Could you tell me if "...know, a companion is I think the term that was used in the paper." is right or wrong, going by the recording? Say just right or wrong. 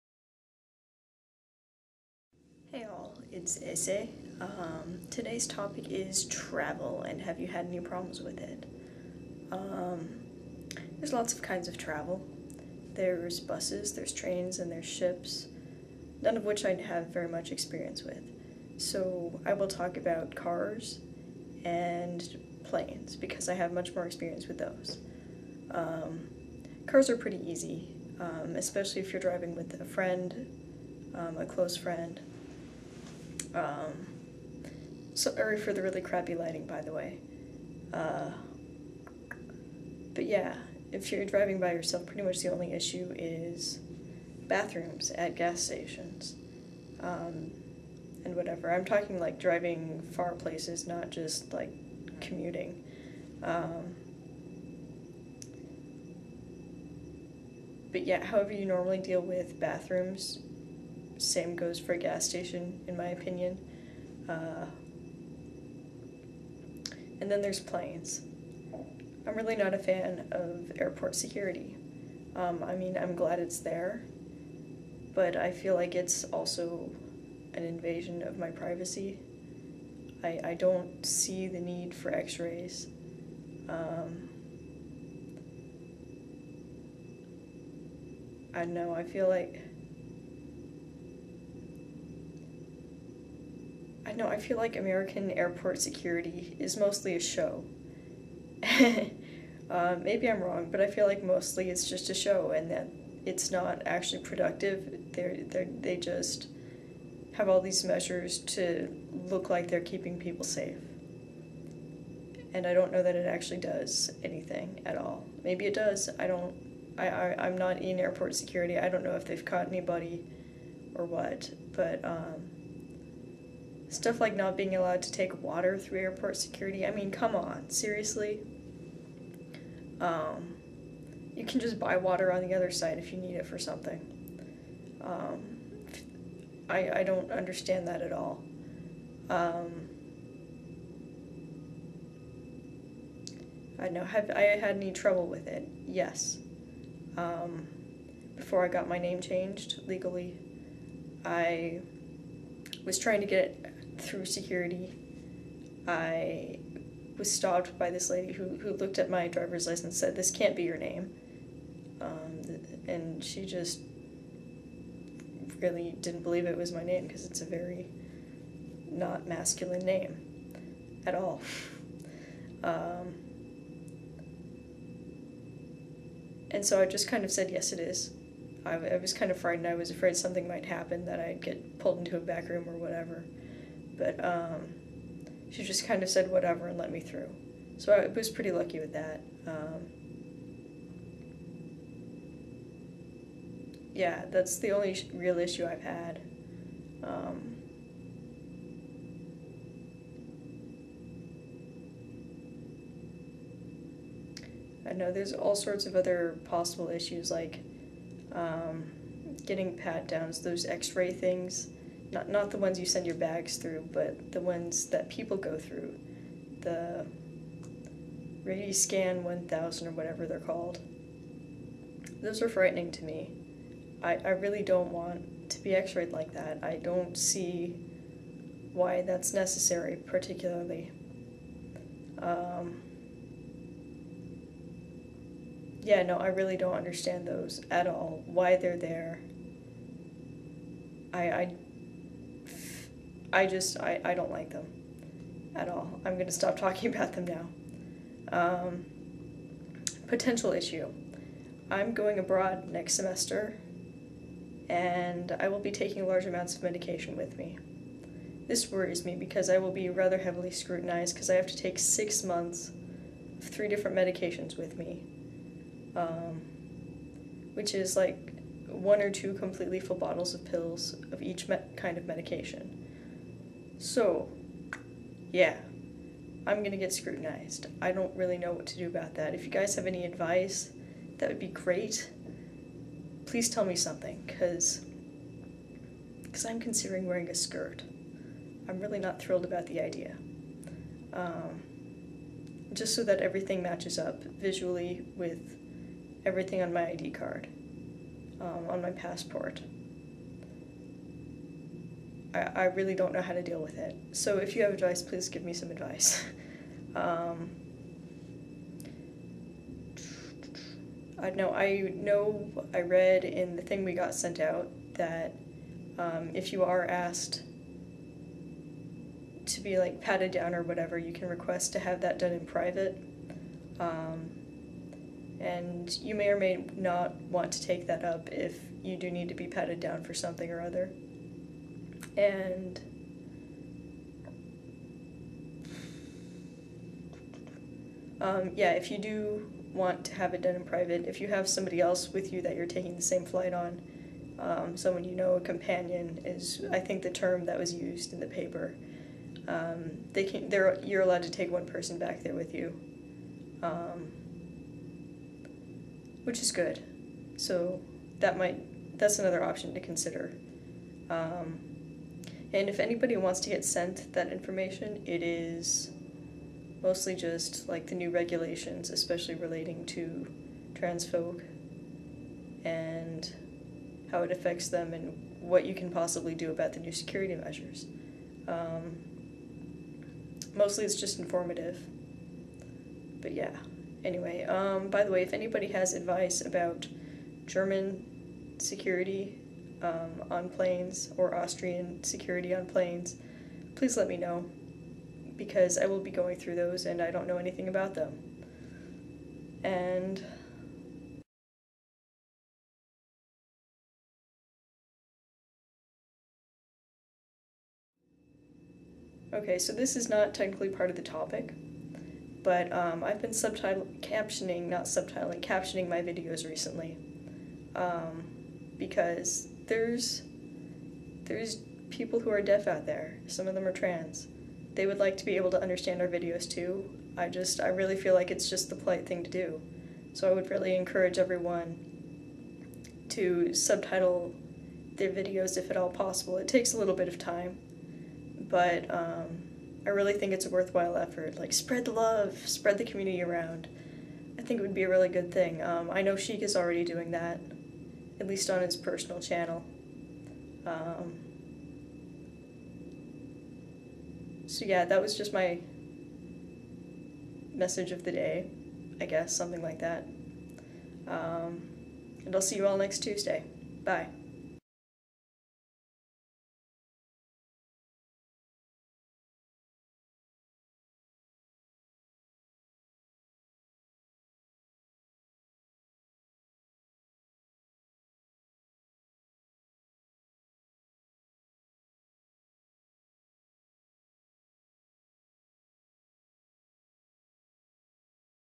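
right.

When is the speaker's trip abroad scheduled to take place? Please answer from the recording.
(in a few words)
Next semester.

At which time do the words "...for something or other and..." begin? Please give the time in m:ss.
5:30.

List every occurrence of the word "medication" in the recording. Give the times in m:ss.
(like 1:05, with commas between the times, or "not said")
4:16, 4:23, 4:32.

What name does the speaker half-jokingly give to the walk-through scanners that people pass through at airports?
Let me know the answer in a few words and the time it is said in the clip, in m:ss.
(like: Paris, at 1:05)
Radiscan 1000, at 3:38.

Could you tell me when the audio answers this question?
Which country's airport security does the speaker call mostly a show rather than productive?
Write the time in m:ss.
1:34.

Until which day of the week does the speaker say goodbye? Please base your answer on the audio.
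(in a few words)
Tuesday.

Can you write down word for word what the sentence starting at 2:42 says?
Um, and she just really didn't believe it was my name because it's a very not masculine name at all.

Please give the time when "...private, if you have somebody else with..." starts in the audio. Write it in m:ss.
5:40.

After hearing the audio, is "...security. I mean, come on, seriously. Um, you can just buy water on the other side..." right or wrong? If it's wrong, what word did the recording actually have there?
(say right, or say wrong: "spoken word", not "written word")
right.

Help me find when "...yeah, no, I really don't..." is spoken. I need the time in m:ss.
3:55.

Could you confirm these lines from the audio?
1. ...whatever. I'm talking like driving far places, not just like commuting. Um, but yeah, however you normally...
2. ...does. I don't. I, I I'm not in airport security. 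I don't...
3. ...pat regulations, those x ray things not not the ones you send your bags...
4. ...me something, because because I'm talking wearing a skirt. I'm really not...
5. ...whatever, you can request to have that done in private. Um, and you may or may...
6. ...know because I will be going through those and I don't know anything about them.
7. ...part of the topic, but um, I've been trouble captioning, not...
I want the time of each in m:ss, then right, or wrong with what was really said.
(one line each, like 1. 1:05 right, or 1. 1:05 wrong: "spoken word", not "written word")
1. 0:48 right
2. 1:55 right
3. 3:29 wrong: "downs", not "regulations"
4. 4:43 wrong: "considering", not "talking"
5. 5:20 right
6. 6:34 right
7. 6:50 wrong: "subtitle", not "trouble".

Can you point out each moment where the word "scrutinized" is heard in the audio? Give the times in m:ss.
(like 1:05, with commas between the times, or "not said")
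4:20, 4:36.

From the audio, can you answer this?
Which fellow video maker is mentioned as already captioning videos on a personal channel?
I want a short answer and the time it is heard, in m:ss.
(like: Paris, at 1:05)
Sheik, at 7:26.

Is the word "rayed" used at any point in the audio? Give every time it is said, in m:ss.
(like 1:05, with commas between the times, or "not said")
3:45.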